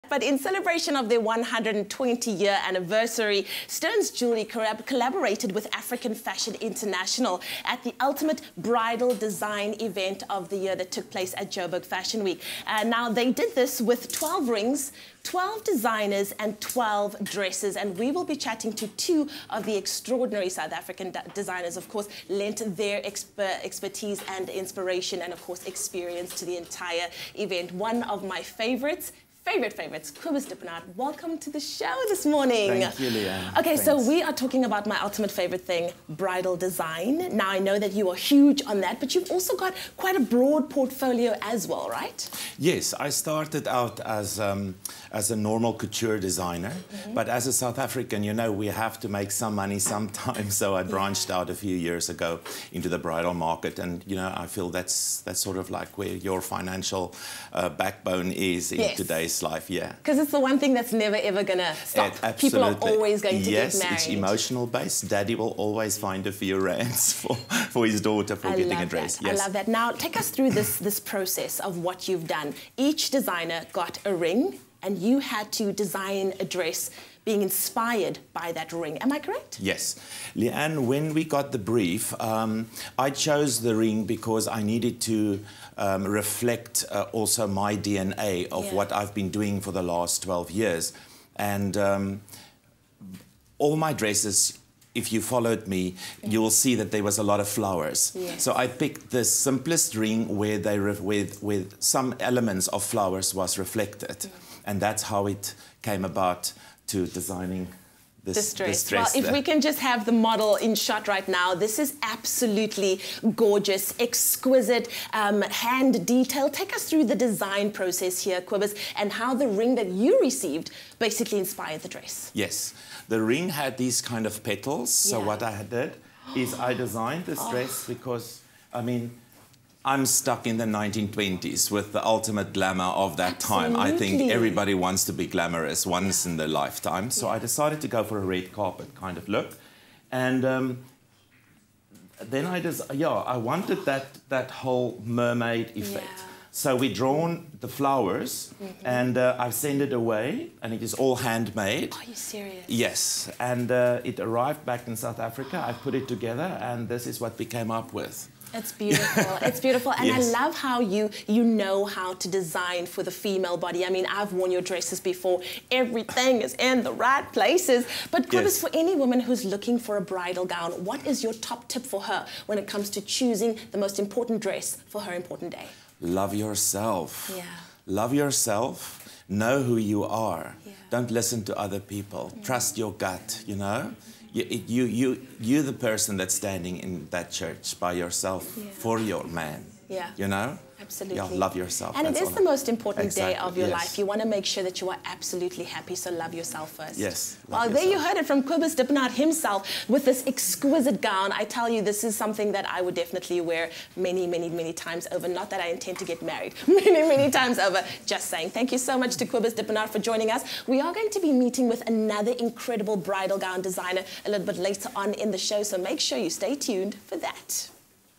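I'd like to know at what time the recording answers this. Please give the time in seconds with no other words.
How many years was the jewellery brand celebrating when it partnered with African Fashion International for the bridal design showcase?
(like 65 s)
1 s.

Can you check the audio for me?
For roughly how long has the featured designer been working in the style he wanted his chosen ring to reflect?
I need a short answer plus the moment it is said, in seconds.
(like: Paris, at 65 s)
12 years, at 90 s.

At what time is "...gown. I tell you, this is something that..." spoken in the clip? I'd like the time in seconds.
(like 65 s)
201 s.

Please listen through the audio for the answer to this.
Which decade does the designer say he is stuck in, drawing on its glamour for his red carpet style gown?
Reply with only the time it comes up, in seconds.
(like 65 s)
130 s.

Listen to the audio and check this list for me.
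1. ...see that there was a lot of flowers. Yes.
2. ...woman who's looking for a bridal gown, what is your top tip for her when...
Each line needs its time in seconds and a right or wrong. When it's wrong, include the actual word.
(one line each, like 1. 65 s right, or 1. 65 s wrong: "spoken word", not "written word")
1. 96 s right
2. 169 s right.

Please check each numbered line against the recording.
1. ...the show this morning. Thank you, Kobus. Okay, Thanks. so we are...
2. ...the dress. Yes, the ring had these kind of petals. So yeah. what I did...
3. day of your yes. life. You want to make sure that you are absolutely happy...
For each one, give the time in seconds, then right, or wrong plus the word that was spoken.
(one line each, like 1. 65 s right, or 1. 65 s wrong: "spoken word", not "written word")
1. 31 s wrong: "Leanne", not "Kobus"
2. 121 s right
3. 193 s right.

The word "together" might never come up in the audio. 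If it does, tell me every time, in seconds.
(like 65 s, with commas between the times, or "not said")
156 s.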